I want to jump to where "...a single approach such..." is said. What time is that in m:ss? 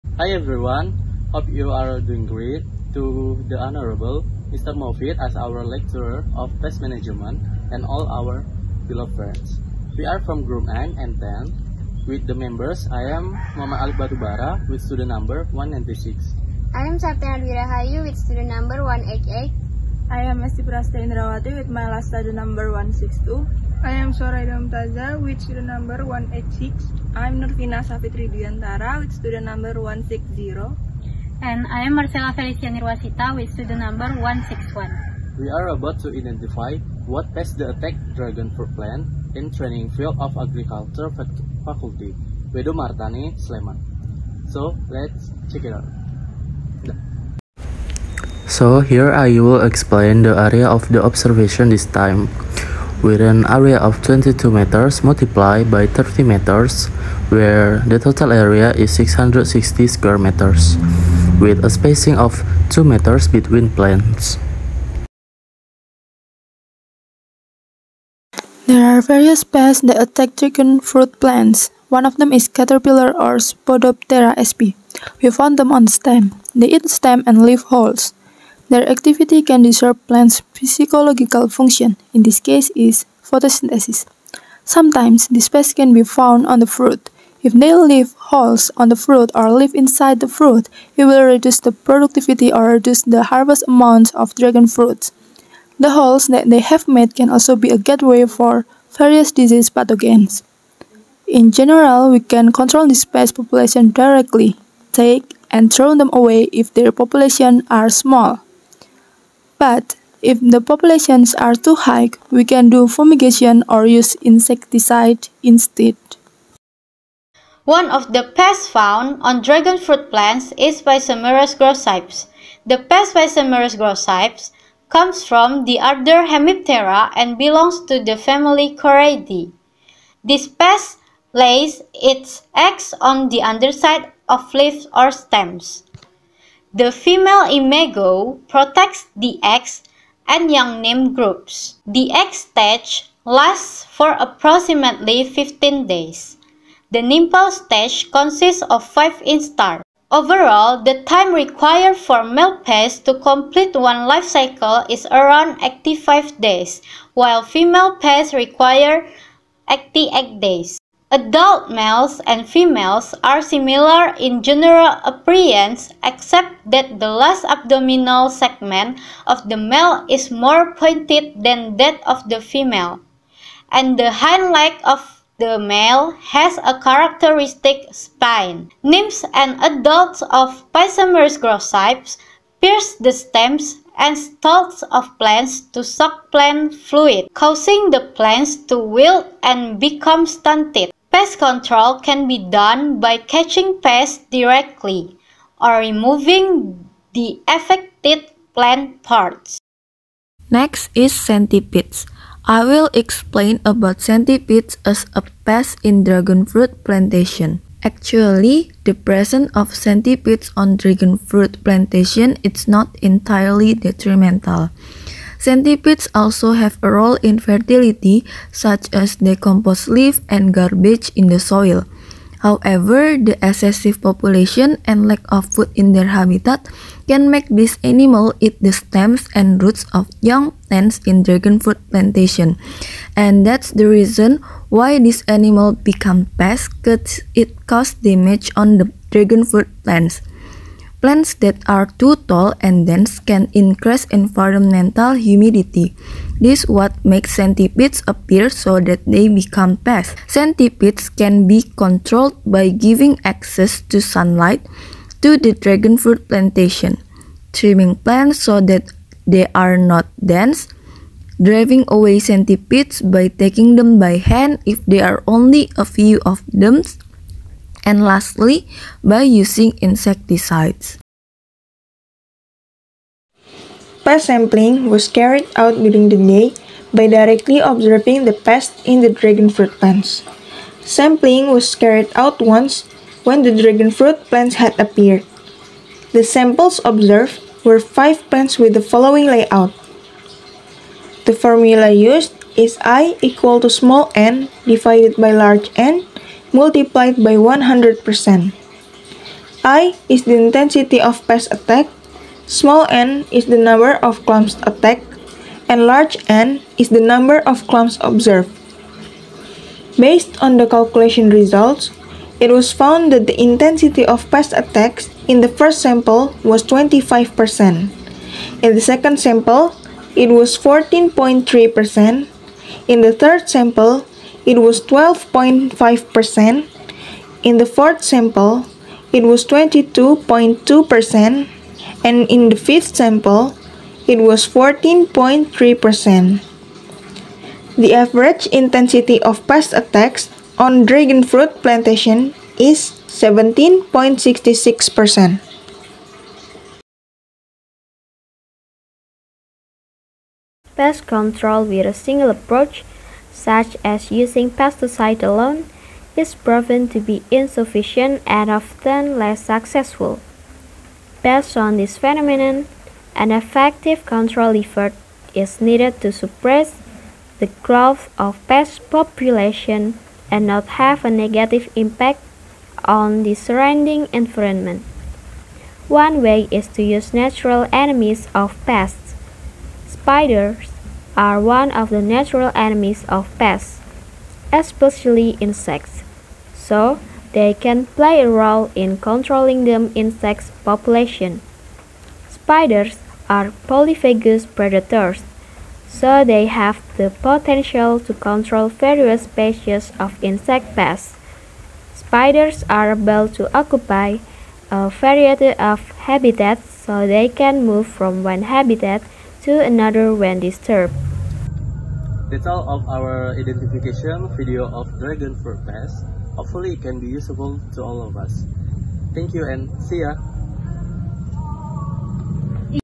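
5:51.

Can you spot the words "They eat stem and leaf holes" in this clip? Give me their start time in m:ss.
1:16.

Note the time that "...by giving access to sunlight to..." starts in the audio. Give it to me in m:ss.
4:12.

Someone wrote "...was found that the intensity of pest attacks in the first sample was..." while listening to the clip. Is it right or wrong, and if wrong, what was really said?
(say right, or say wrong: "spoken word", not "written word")
right.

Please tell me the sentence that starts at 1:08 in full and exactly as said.
There are various pests that attack chicken fruit plants.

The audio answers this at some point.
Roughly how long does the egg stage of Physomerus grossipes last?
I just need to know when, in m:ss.
2:25.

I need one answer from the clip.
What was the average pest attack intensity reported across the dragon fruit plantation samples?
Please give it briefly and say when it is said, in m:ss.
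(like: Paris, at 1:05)
17.66%, at 5:43.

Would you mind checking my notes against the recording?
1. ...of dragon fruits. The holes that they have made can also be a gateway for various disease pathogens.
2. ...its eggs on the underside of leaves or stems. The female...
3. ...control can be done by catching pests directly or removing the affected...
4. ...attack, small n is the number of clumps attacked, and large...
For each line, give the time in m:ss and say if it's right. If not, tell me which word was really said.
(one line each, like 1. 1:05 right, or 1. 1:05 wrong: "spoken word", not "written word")
1. 1:34 right
2. 2:11 right
3. 3:11 right
4. 5:01 right.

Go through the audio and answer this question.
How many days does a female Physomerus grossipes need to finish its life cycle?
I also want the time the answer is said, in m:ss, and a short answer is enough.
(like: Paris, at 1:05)
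88 days, at 2:39.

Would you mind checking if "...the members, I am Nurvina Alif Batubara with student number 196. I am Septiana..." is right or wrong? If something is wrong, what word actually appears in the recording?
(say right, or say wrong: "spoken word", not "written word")
wrong: "Mama", not "Nurvina".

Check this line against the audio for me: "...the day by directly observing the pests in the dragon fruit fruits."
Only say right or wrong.
wrong.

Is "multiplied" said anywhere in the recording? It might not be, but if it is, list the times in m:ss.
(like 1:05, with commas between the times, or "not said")
0:55, 4:56.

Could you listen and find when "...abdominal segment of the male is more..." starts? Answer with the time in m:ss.
2:47.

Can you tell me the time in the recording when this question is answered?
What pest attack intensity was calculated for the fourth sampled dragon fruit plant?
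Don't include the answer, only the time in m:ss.
5:29.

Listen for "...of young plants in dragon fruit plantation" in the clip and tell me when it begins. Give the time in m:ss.
3:49.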